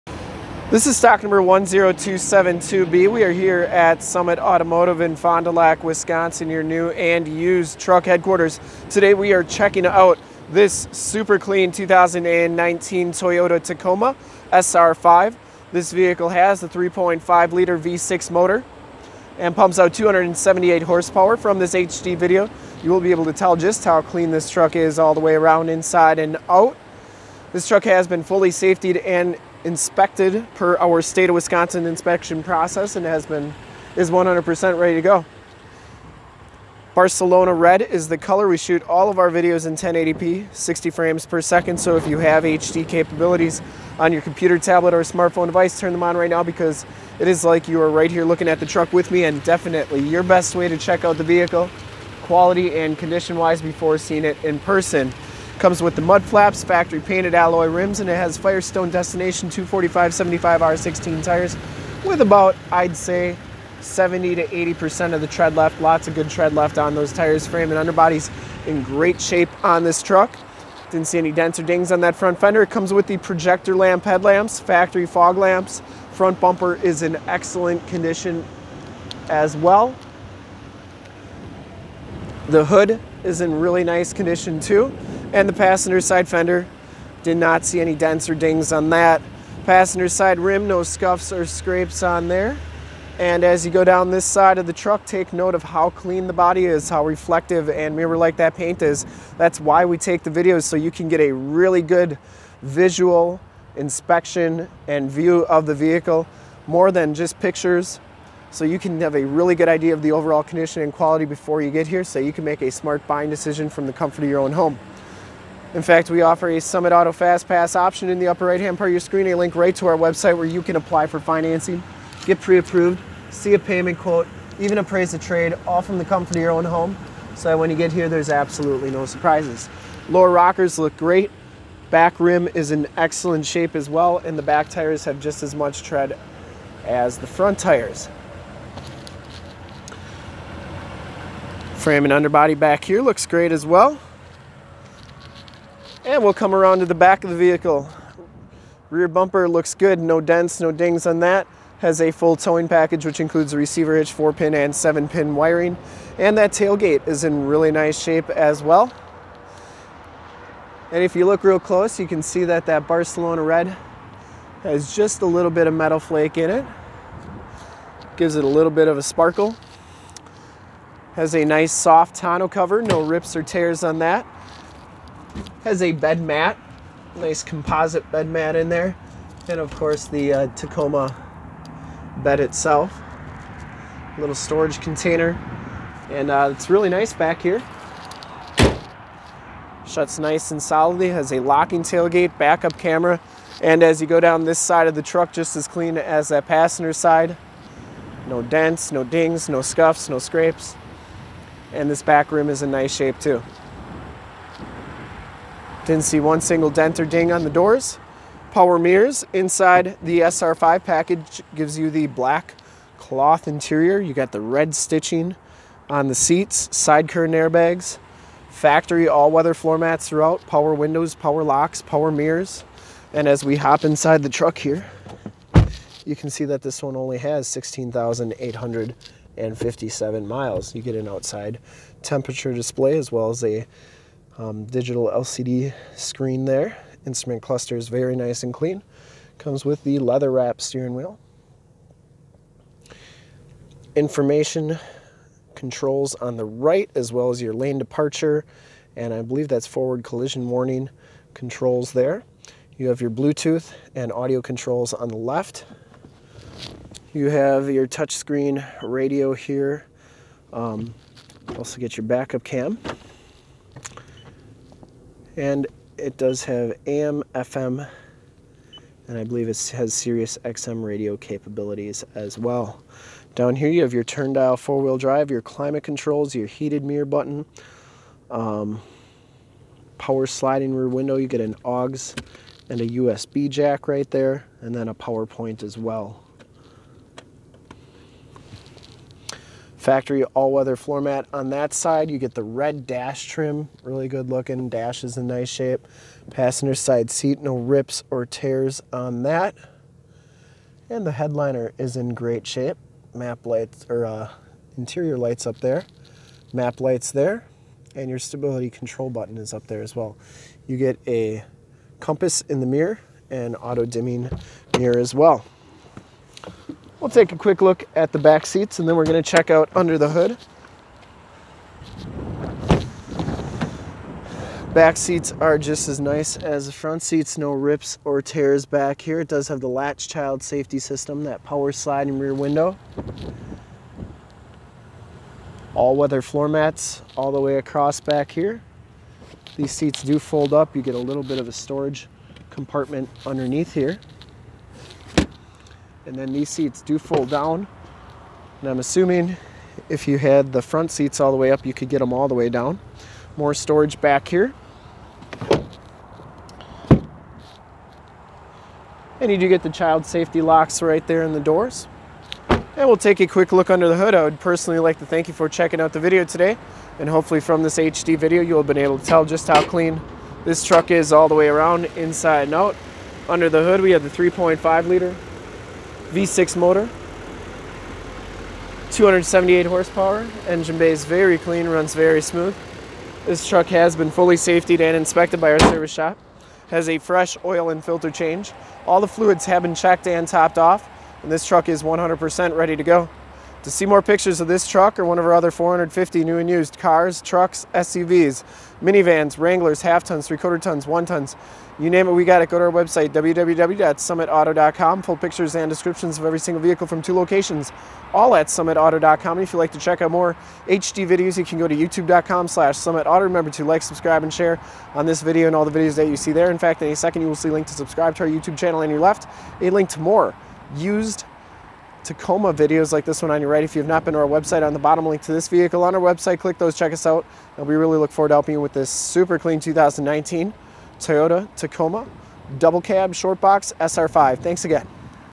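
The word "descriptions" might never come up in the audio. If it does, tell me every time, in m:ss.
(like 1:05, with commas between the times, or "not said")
6:45.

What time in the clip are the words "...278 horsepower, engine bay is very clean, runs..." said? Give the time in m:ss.
6:18.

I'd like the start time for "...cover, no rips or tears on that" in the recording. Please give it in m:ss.
2:52.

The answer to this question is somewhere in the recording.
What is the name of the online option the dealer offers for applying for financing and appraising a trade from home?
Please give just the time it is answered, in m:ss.
1:56.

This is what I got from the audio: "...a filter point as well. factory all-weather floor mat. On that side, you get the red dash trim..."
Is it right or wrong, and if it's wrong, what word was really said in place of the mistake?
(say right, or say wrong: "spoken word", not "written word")
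wrong: "power", not "filter".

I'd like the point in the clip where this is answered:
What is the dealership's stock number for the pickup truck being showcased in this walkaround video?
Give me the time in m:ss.
0:01.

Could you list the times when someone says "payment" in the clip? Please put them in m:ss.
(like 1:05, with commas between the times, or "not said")
2:03.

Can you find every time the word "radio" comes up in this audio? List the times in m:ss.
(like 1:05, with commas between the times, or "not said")
4:18, 4:30.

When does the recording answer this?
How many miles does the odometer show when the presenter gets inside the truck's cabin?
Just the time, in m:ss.
3:47.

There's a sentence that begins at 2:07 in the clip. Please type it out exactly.
So that when you get here, there's absolutely no surprises.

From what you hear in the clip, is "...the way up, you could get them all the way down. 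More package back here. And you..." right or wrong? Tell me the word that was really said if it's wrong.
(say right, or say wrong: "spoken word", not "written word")
wrong: "storage", not "package".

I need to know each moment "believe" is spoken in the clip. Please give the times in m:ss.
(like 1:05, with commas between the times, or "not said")
4:09, 4:29.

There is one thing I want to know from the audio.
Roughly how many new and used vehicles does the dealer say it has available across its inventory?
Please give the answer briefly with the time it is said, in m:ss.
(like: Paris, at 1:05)
450, at 6:35.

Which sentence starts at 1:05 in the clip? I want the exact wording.
Lots of good tread left on those tires.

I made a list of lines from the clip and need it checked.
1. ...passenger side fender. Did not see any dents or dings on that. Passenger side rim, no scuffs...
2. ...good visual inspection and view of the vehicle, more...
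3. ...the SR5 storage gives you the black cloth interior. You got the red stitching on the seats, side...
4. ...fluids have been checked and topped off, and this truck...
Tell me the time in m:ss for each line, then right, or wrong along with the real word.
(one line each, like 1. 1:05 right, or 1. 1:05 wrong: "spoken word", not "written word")
1. 1:25 right
2. 1:41 right
3. 3:30 wrong: "package", not "storage"
4. 6:29 right.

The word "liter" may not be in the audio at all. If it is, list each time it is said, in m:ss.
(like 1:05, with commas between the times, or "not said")
0:17, 6:14.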